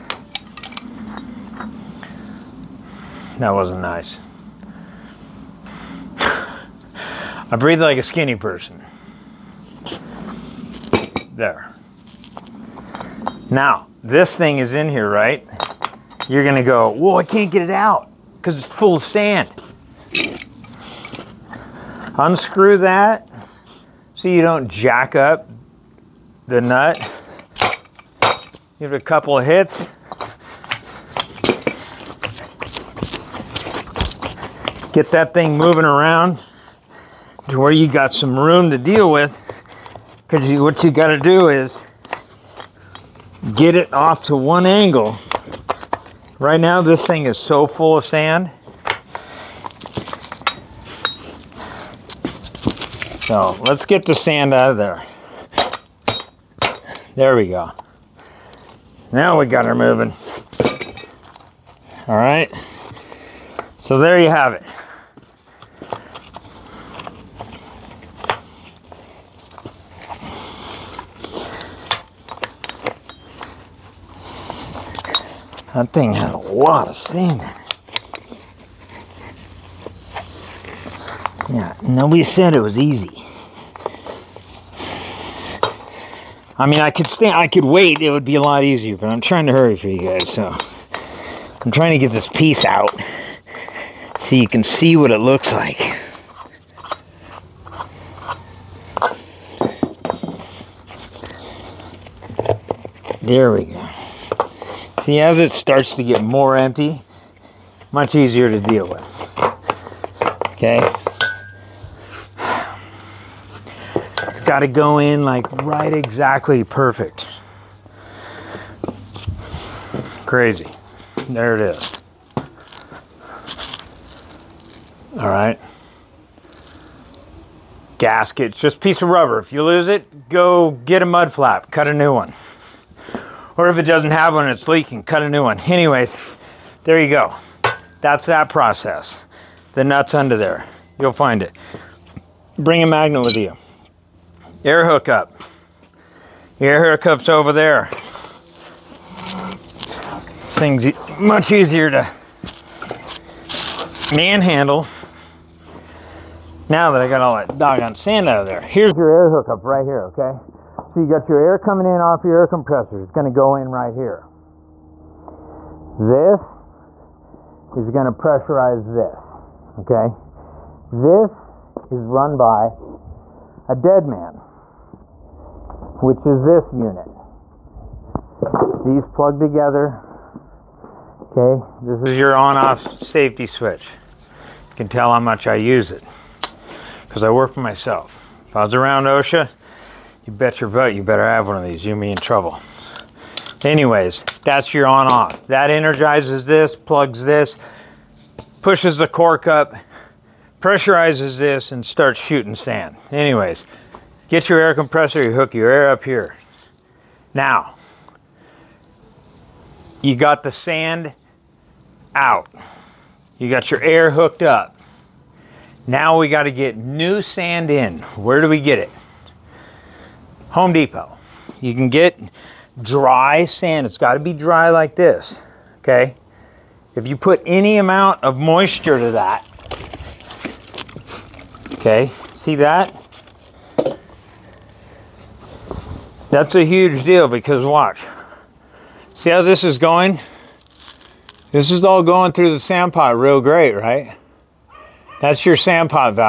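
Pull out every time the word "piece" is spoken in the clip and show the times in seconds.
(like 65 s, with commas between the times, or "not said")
92 s, 128 s.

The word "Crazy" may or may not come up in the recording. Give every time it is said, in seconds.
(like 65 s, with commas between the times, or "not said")
120 s.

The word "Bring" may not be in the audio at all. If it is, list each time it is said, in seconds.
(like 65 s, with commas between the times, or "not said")
142 s.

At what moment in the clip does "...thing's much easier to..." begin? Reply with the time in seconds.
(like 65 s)
150 s.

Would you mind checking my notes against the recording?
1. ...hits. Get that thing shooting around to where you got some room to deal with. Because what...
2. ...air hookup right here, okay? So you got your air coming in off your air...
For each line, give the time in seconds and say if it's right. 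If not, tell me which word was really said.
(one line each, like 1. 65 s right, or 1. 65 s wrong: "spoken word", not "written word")
1. 29 s wrong: "moving", not "shooting"
2. 159 s right.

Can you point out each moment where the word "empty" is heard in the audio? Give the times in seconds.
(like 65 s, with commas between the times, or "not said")
106 s.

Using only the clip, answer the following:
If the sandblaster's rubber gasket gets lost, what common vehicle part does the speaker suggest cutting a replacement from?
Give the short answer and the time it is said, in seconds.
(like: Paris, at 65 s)
mud flap, at 131 s.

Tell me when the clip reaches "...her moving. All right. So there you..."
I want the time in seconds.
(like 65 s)
59 s.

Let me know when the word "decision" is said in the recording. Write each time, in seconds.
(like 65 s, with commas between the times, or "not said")
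not said.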